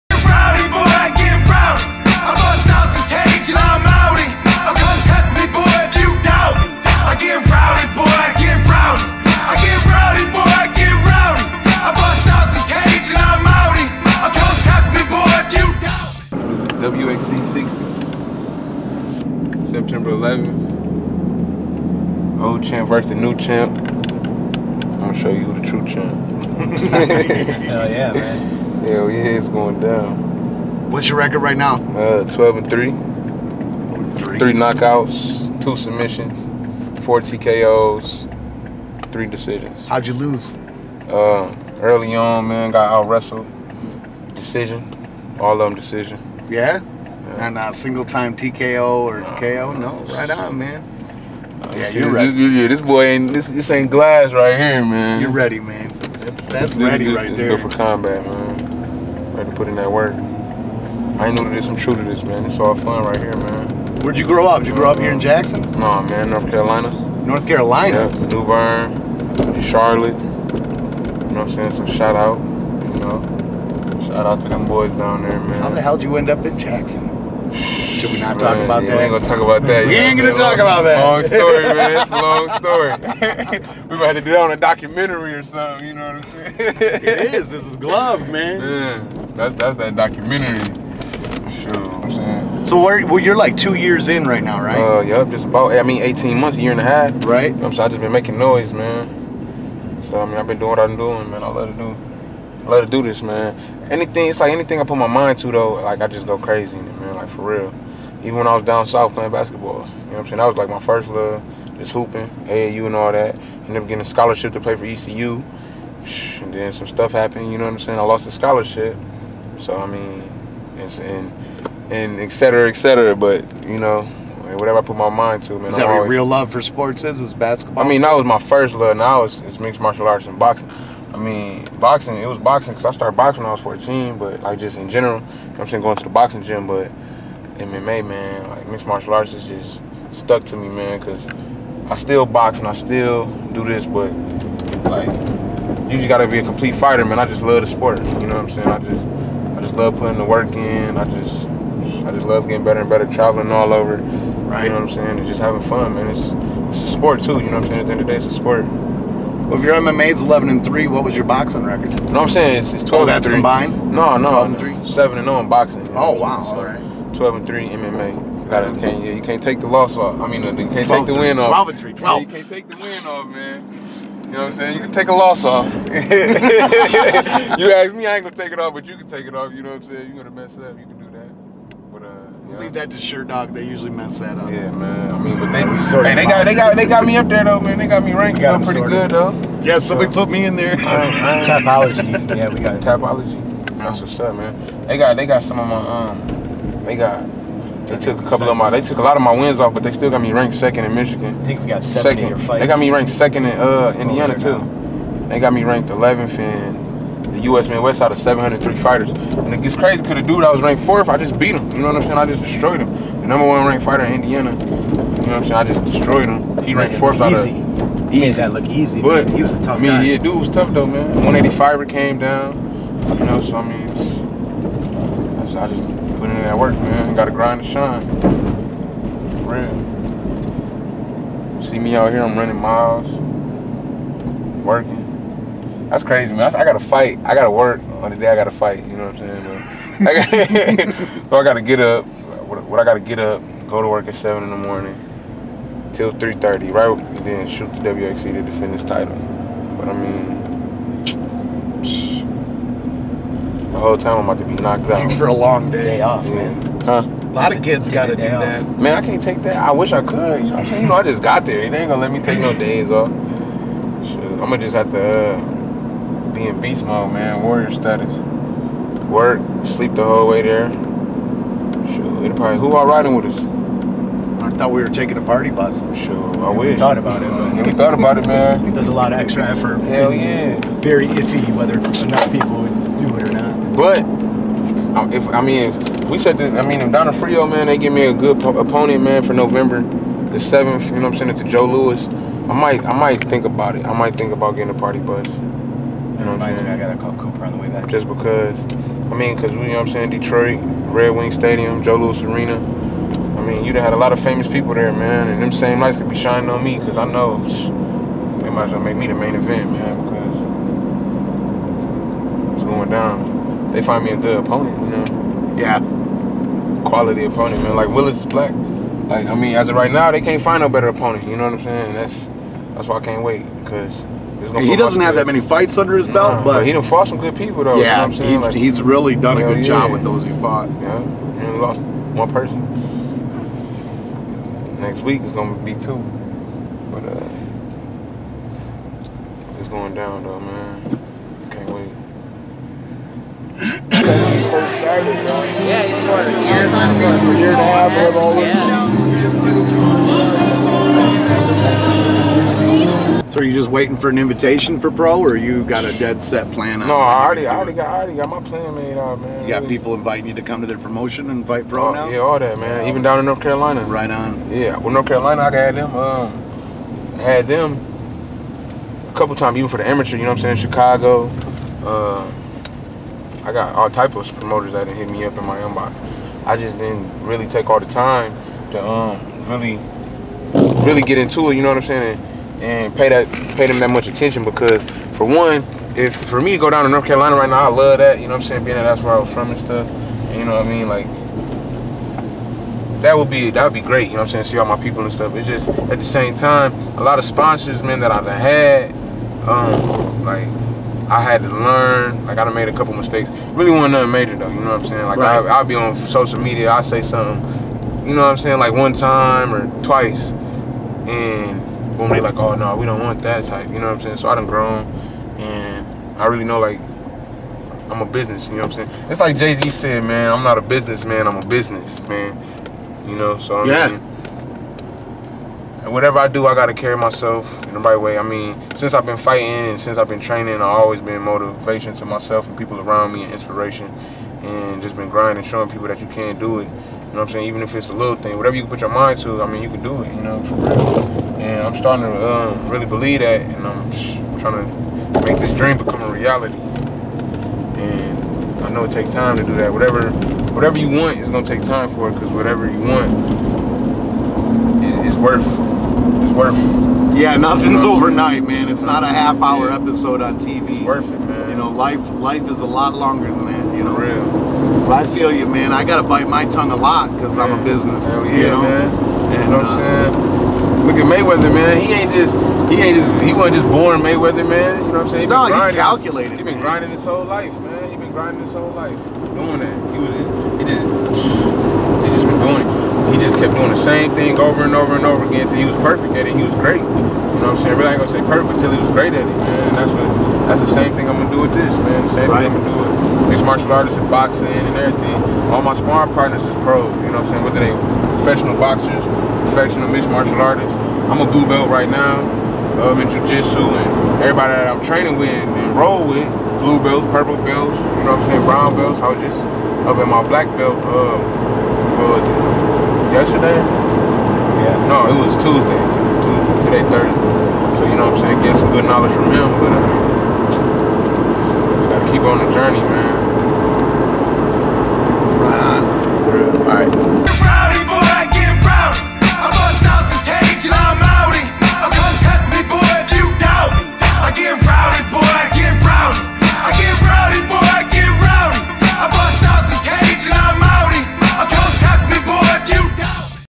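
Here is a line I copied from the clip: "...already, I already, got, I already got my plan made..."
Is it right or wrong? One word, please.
right.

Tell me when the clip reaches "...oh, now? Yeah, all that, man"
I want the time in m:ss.
6:01.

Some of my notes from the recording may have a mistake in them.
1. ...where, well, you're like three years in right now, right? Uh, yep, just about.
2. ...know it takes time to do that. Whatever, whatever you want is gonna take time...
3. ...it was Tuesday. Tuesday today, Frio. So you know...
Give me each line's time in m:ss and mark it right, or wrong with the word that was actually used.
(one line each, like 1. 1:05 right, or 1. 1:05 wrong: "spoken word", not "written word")
1. 1:32 wrong: "two", not "three"
2. 7:28 right
3. 8:35 wrong: "Thursday", not "Frio".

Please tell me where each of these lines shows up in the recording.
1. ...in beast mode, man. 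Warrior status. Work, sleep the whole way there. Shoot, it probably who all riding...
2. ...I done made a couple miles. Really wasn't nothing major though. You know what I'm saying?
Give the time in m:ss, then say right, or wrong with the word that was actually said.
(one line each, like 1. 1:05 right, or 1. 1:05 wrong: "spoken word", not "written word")
1. 4:26 right
2. 6:42 wrong: "mistakes", not "miles".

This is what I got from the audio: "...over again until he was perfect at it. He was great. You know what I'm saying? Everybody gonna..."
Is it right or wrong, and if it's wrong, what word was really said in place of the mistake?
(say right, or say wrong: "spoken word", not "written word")
right.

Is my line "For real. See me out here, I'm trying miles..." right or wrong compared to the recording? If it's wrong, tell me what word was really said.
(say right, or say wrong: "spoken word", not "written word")
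wrong: "running", not "trying".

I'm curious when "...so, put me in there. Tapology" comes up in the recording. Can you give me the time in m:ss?
3:10.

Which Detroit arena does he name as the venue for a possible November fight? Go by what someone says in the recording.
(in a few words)
Joe Louis Arena.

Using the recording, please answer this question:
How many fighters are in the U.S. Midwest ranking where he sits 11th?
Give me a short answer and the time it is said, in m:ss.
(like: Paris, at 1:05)
703, at 3:28.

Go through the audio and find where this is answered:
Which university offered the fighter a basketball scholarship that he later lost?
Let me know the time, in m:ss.
1:54.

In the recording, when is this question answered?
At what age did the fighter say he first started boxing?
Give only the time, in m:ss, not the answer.
2:13.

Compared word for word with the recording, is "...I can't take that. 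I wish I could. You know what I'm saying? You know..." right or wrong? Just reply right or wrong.
right.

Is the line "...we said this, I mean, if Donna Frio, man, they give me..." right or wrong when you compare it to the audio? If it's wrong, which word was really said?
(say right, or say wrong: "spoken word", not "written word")
right.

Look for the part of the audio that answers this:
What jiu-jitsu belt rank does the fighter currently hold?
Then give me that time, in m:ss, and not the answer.
8:21.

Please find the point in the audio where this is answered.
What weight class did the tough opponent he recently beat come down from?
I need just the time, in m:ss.
3:41.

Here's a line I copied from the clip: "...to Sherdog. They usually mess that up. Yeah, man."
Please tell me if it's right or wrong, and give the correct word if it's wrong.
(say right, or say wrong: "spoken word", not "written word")
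right.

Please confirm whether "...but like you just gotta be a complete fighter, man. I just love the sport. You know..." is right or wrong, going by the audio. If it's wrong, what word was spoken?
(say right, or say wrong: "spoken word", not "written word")
right.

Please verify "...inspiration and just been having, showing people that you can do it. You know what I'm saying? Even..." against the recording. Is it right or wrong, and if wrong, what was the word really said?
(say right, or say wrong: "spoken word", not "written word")
wrong: "grinding", not "having".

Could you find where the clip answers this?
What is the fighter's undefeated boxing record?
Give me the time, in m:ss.
2:44.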